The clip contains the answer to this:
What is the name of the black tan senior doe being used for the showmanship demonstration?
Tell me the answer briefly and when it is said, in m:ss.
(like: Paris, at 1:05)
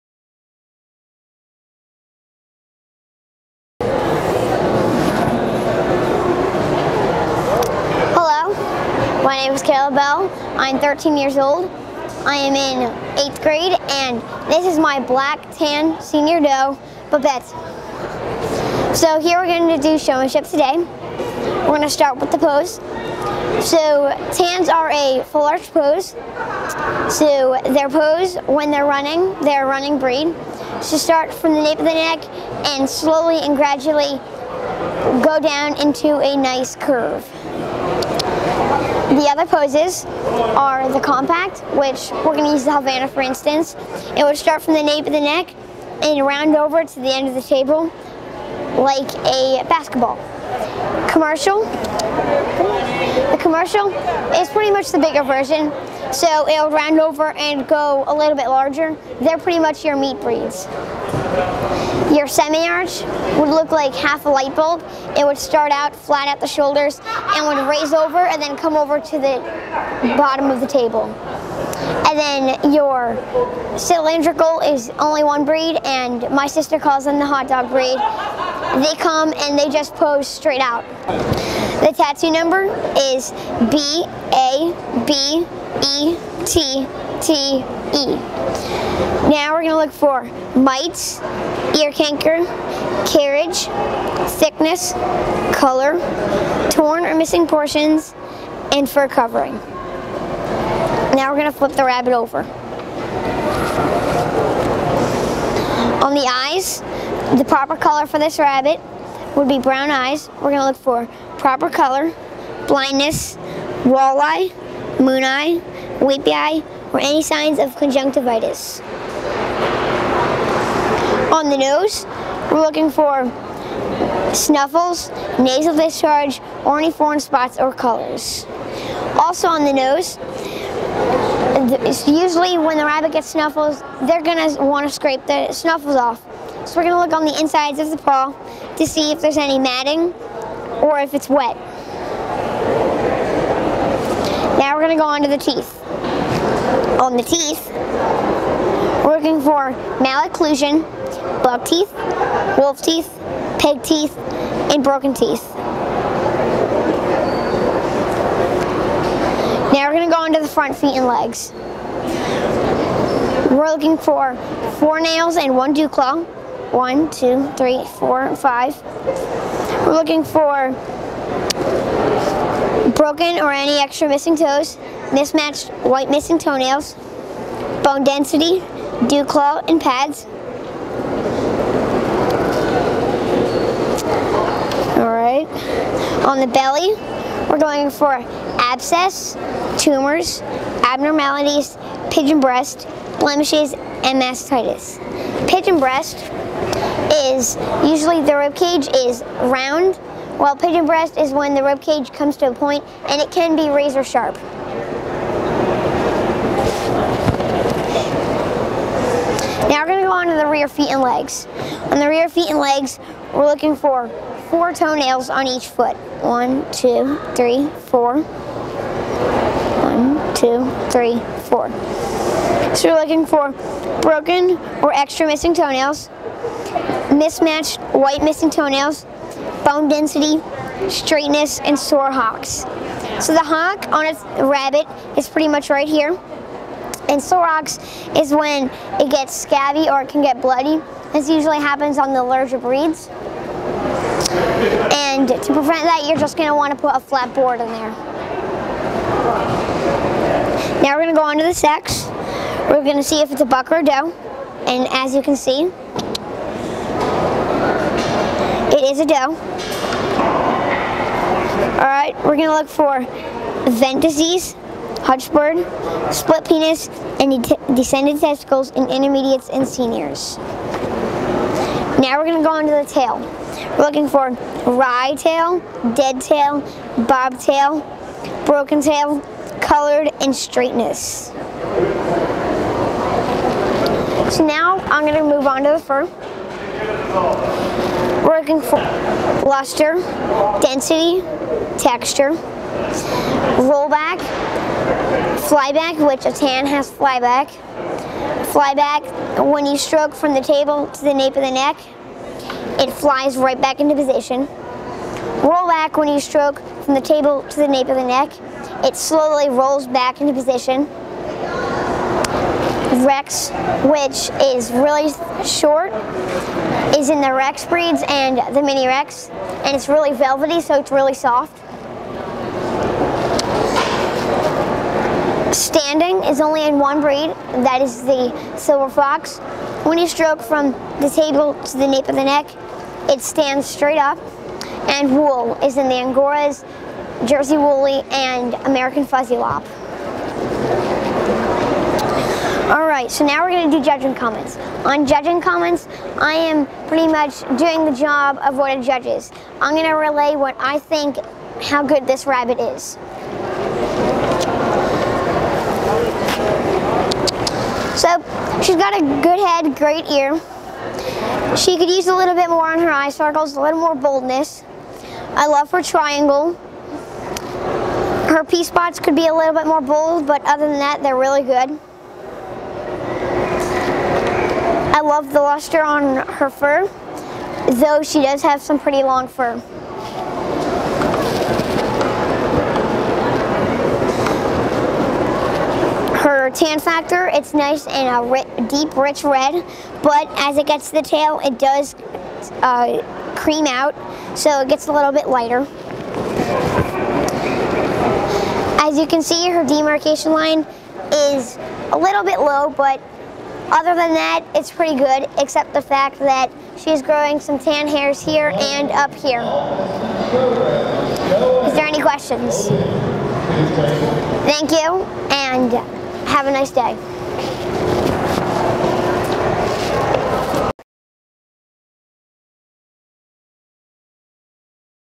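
Babette, at 0:17.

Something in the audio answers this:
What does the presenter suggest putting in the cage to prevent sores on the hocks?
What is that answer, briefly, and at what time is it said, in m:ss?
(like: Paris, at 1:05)
a flat board, at 4:06.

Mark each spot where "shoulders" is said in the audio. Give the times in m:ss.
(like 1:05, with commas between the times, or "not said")
1:06.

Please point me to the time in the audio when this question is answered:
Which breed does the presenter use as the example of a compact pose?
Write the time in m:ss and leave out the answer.
0:42.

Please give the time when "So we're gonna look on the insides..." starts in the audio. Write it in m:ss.
2:16.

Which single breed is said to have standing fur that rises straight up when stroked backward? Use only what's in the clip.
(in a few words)
Silver Fox.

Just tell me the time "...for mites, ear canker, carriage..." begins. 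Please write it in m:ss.
1:29.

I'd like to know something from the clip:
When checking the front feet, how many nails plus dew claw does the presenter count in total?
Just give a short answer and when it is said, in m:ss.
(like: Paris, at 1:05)
5, at 2:48.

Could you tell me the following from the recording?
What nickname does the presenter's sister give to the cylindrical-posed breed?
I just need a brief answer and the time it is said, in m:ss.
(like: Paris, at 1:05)
hot dog breed, at 1:17.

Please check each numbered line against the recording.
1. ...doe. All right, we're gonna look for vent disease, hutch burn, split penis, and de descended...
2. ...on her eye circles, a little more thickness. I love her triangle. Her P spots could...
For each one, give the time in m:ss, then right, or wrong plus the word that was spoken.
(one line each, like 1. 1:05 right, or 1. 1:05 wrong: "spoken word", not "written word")
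1. 4:19 right
2. 6:02 wrong: "boldness", not "thickness".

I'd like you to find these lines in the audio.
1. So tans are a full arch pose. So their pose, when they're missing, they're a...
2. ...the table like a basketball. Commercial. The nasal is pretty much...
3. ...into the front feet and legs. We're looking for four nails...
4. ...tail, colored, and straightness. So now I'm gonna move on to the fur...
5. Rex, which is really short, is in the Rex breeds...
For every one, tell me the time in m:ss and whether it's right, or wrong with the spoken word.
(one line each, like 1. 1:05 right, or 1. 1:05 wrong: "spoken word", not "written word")
1. 0:23 wrong: "running", not "missing"
2. 0:47 wrong: "commercial", not "nasal"
3. 2:40 right
4. 4:38 right
5. 5:13 right.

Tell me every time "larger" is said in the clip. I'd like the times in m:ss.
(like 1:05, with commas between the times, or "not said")
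0:58, 4:02.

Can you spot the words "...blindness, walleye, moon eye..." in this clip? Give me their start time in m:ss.
1:52.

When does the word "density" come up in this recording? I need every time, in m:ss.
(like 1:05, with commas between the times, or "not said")
2:58, 3:49, 4:50.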